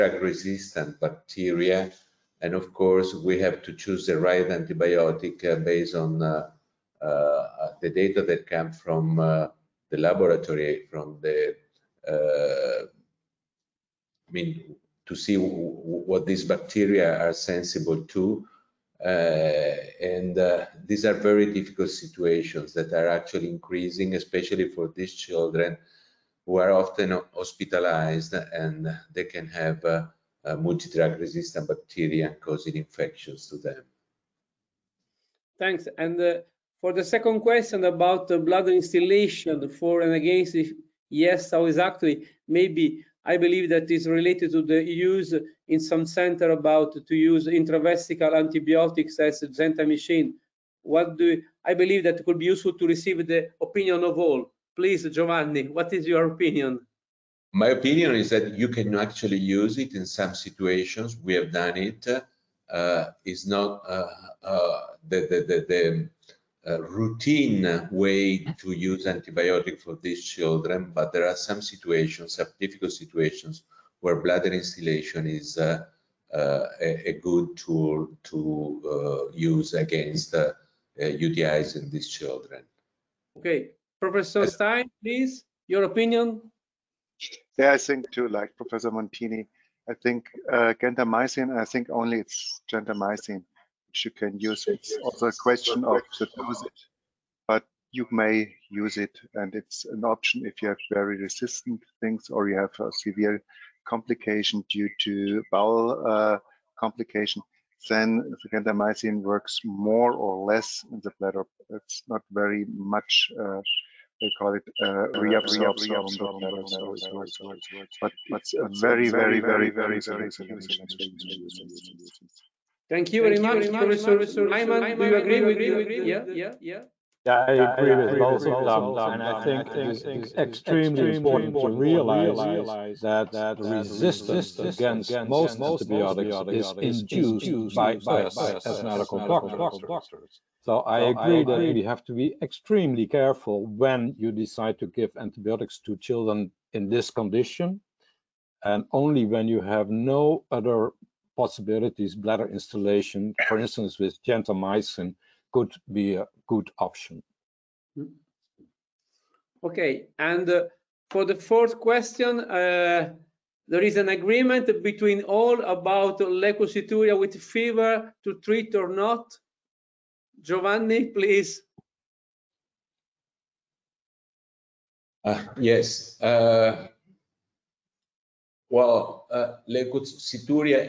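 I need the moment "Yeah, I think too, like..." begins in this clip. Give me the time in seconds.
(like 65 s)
87 s.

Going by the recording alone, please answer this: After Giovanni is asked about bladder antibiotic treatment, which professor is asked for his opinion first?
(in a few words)
Professor Stein.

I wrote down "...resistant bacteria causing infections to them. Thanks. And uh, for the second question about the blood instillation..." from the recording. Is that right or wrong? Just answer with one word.
right.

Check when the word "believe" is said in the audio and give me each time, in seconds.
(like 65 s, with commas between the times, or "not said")
43 s, 51 s.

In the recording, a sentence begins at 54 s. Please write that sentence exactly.
Please, Giovanni, what is your opinion?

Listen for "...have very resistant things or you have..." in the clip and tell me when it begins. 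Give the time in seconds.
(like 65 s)
100 s.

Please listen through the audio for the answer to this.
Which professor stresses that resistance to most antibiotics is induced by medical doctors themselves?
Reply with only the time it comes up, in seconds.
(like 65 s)
123 s.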